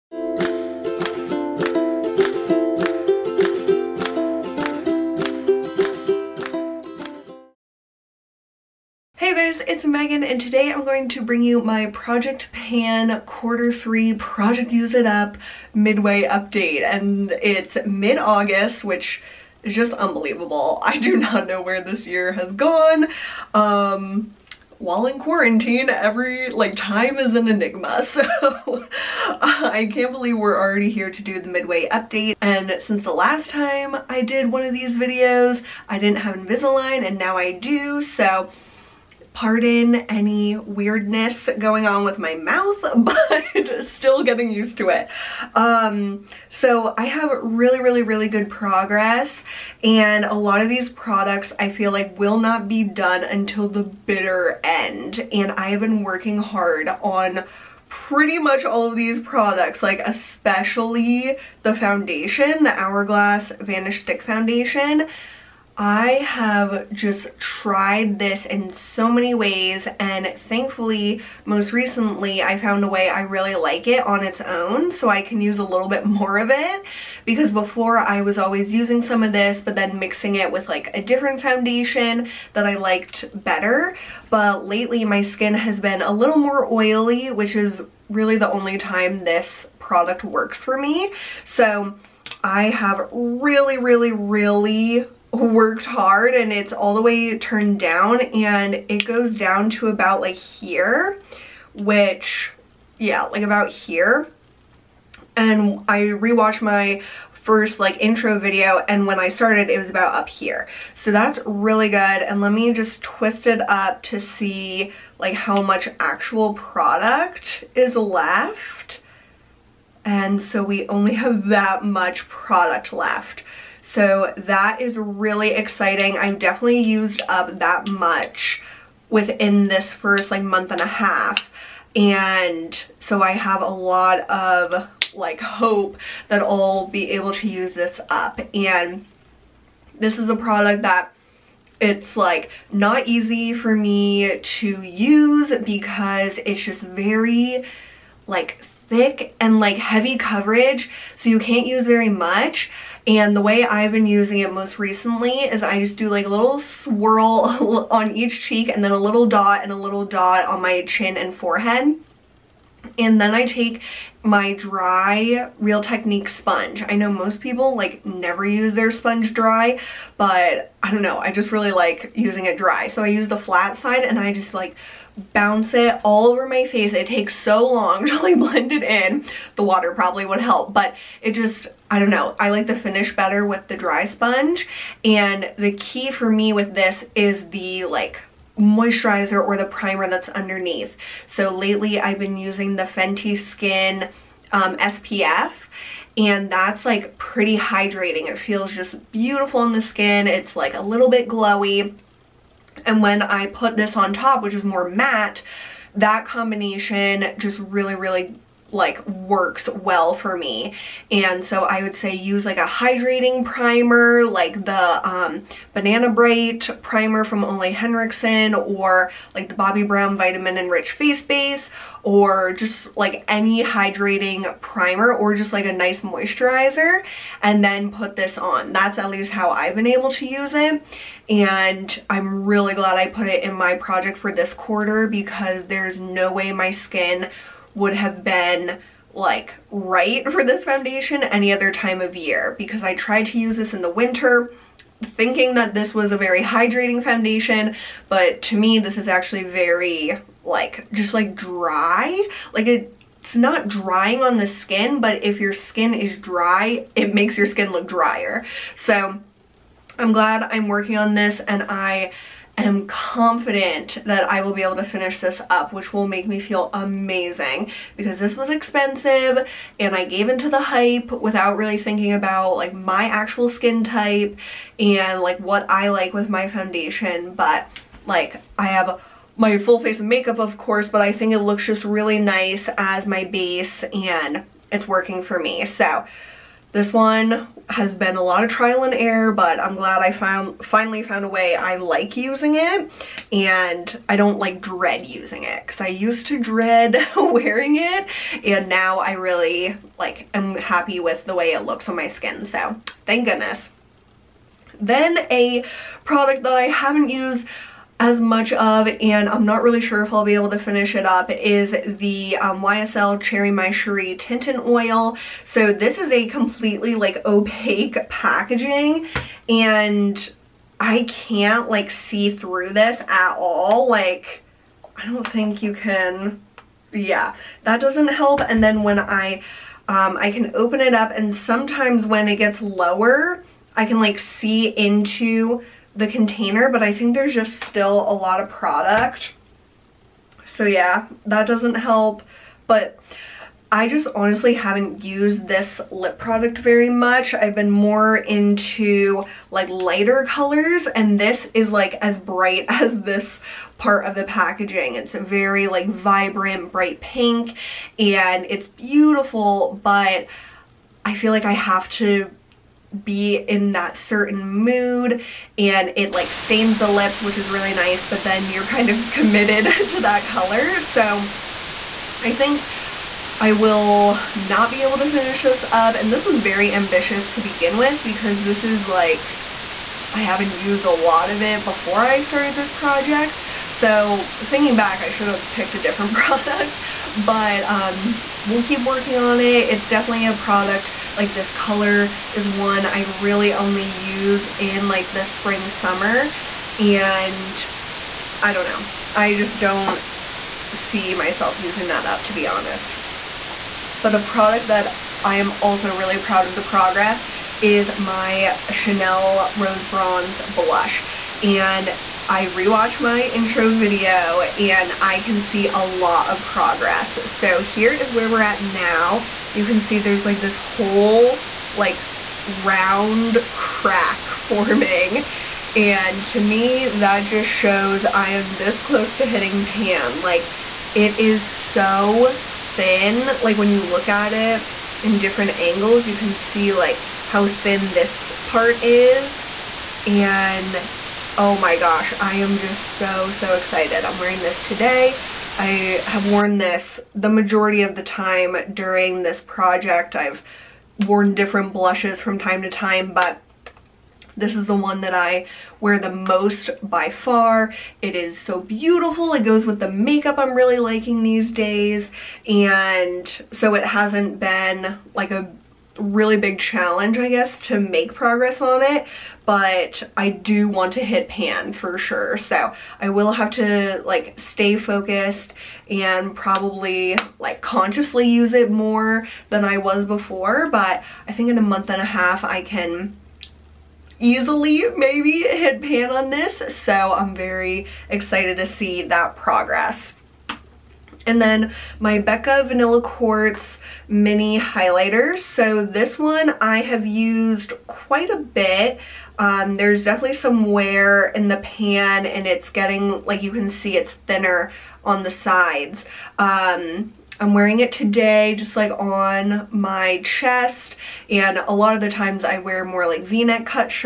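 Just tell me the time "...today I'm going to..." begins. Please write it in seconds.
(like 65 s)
10 s.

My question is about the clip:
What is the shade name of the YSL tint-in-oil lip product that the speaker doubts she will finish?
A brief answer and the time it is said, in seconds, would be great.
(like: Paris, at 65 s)
Cherry My Cherie, at 313 s.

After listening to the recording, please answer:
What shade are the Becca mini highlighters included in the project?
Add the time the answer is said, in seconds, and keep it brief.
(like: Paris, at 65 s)
Vanilla Quartz, at 492 s.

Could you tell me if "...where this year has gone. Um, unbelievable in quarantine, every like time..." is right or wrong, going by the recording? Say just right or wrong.
wrong.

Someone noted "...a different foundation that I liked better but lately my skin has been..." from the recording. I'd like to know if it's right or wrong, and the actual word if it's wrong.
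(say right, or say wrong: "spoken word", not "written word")
right.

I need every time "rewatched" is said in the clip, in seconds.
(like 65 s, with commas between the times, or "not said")
105 s, 412 s.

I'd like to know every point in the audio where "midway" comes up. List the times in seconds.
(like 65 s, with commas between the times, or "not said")
15 s, 31 s.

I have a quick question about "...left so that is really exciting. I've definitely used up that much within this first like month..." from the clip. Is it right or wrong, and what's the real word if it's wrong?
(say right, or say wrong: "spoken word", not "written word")
right.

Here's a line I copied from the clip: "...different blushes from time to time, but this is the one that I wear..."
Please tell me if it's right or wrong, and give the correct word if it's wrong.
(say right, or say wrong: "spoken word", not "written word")
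right.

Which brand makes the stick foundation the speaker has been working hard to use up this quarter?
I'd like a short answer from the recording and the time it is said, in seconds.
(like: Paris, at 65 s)
Hourglass, at 62 s.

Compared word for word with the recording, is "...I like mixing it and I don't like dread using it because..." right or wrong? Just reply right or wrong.
wrong.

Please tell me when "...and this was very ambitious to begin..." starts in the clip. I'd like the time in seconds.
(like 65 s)
375 s.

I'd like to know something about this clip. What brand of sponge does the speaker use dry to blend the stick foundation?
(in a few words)
Real Technique.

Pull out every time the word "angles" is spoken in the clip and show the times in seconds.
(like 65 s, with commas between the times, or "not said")
435 s.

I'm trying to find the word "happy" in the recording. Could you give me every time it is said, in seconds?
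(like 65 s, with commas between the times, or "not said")
300 s.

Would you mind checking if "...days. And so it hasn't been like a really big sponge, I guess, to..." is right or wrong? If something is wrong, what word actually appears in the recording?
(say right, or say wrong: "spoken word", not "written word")
wrong: "challenge", not "sponge".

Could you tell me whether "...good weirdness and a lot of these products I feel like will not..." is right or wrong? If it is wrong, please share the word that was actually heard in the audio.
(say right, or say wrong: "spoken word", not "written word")
wrong: "progress", not "weirdness".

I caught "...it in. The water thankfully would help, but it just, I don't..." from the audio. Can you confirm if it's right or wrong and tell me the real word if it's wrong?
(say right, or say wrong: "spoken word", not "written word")
wrong: "probably", not "thankfully".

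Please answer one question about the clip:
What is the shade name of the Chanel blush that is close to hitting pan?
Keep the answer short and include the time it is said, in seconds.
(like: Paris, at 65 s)
Rose Bronze, at 409 s.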